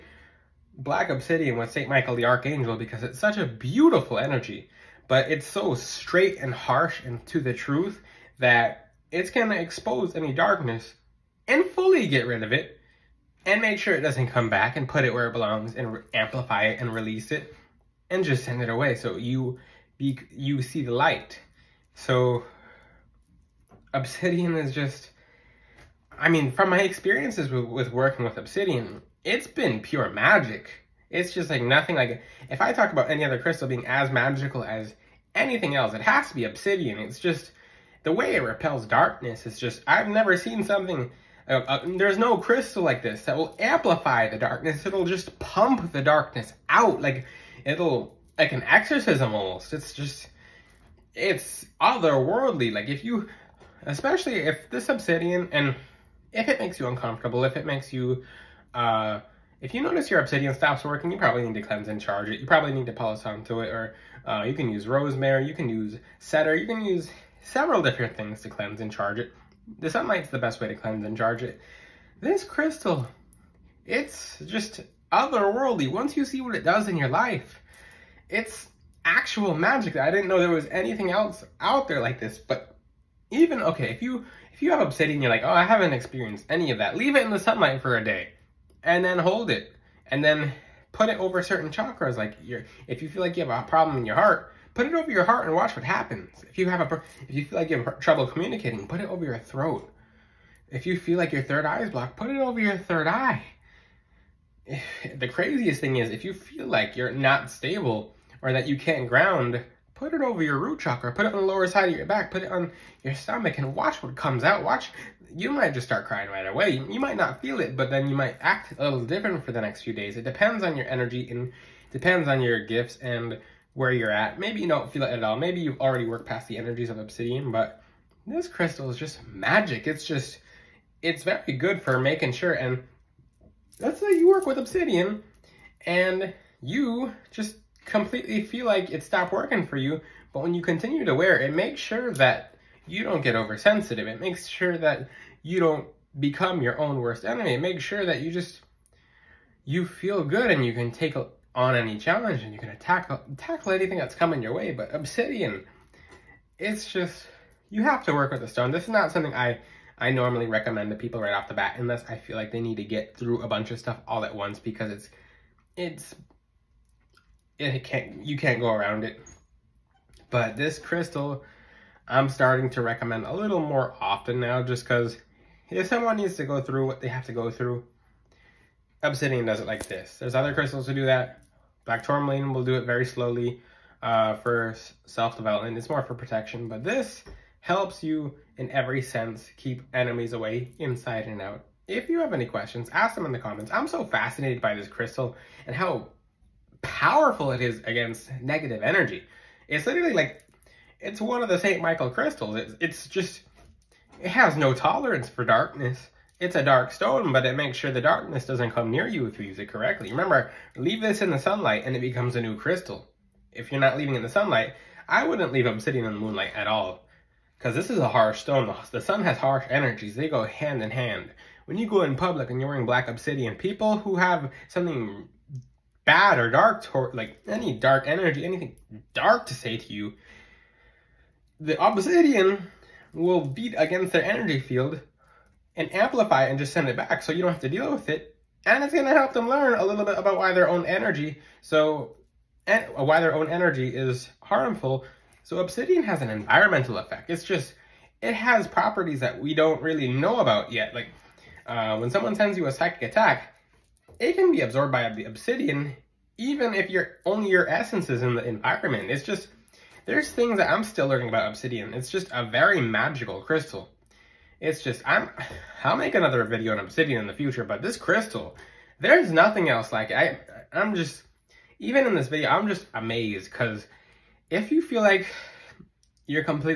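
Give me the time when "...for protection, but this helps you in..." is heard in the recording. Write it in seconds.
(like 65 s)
186 s.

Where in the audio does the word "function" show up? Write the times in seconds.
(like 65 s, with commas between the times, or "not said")
not said.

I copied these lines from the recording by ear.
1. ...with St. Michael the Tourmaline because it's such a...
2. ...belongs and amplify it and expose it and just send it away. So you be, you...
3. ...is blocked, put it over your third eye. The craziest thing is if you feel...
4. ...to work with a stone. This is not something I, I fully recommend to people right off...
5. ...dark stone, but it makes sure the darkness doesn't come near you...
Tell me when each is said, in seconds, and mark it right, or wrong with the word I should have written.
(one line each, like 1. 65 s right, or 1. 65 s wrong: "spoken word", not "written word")
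1. 1 s wrong: "Archangel", not "Tourmaline"
2. 15 s wrong: "release", not "expose"
3. 101 s right
4. 158 s wrong: "normally", not "fully"
5. 206 s right.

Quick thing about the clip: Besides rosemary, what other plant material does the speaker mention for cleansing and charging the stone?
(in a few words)
Cedar.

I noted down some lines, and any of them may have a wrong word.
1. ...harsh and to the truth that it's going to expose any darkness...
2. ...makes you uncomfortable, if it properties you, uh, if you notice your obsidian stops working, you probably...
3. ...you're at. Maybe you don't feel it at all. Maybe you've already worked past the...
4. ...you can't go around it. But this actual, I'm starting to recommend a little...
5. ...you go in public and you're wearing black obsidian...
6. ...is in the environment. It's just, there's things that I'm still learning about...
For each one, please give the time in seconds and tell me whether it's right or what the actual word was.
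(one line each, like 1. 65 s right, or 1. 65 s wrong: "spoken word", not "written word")
1. 6 s right
2. 56 s wrong: "makes", not "properties"
3. 123 s right
4. 168 s wrong: "crystal", not "actual"
5. 221 s right
6. 258 s right.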